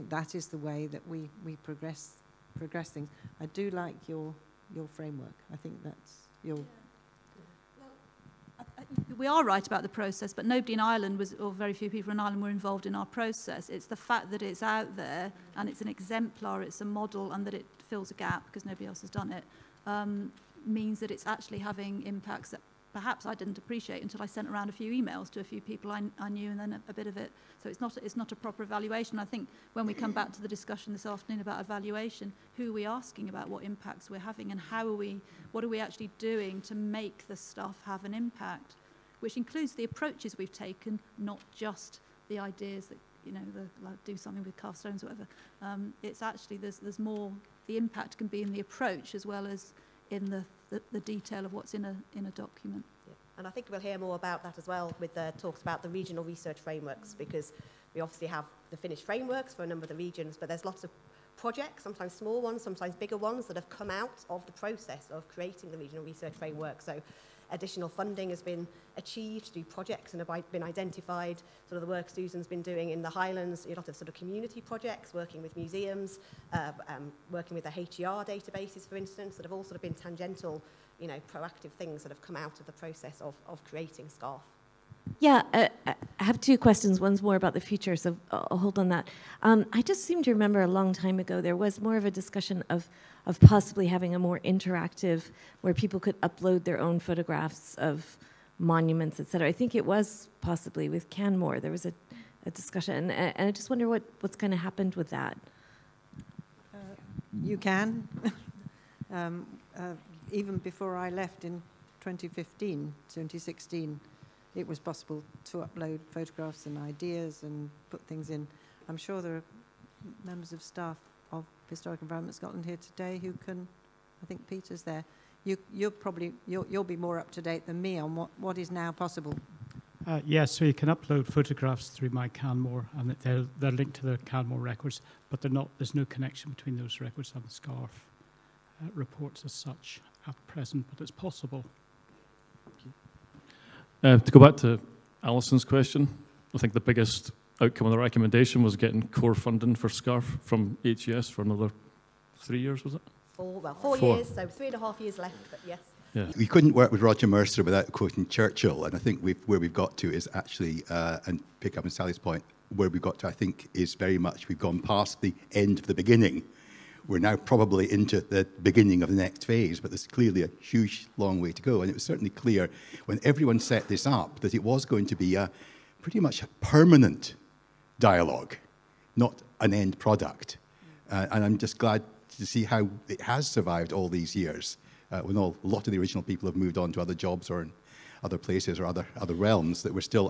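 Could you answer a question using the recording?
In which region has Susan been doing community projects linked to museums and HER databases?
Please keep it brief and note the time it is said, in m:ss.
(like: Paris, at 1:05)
the Highlands, at 1:13.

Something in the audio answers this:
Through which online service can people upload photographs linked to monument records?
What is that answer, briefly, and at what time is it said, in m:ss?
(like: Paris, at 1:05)
My Canmore, at 2:12.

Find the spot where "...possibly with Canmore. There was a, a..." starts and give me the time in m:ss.
1:40.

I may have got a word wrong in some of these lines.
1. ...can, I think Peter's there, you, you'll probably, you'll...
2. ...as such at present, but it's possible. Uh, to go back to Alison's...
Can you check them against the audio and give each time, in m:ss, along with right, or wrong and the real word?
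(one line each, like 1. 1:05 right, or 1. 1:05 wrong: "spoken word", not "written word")
1. 2:03 right
2. 2:19 right.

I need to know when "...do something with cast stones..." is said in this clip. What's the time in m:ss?
0:44.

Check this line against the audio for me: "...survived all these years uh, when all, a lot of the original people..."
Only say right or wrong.
right.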